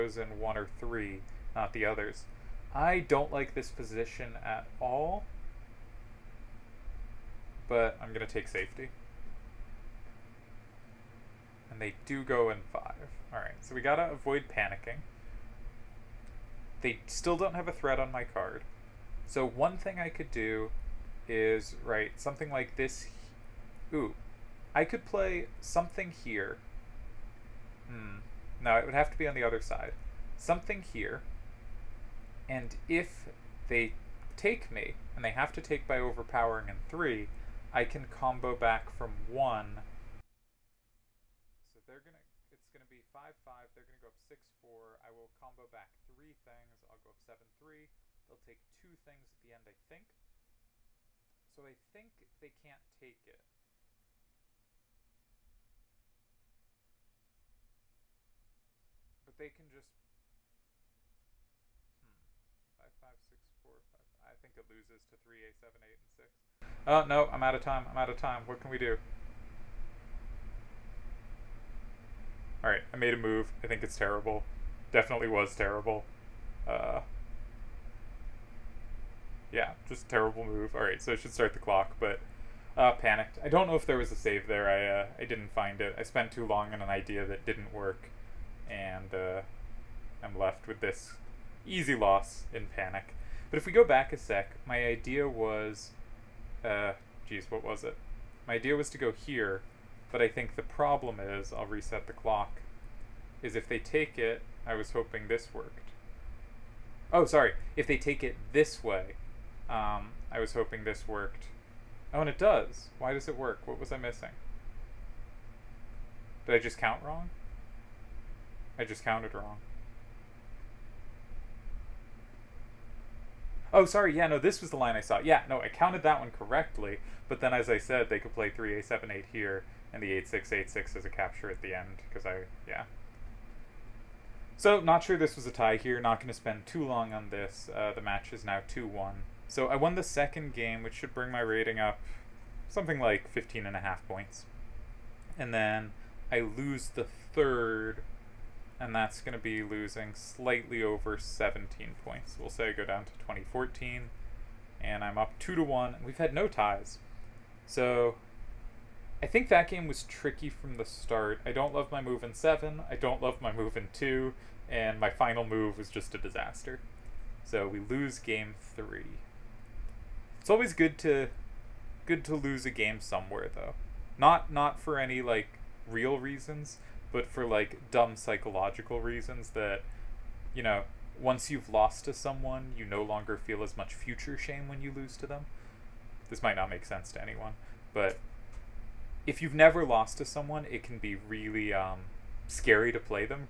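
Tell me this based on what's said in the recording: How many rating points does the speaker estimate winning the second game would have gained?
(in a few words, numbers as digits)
15.5.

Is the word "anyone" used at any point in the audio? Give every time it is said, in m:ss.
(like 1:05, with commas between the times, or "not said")
3:07.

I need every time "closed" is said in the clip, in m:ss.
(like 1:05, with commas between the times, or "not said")
not said.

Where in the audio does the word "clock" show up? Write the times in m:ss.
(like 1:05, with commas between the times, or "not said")
1:21, 1:42.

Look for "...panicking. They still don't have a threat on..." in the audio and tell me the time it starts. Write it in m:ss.
0:14.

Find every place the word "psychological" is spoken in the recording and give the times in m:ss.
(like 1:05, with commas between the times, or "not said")
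2:58.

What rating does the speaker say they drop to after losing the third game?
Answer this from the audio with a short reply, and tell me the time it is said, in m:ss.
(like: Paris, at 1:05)
2014, at 2:33.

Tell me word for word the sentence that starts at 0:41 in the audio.
So they're going to, it's going to be 5-5, five, five.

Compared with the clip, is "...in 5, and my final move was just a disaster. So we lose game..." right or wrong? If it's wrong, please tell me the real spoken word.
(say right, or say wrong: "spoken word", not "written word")
wrong: "2", not "5".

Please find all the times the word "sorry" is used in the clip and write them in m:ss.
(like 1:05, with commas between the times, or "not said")
1:47, 2:03.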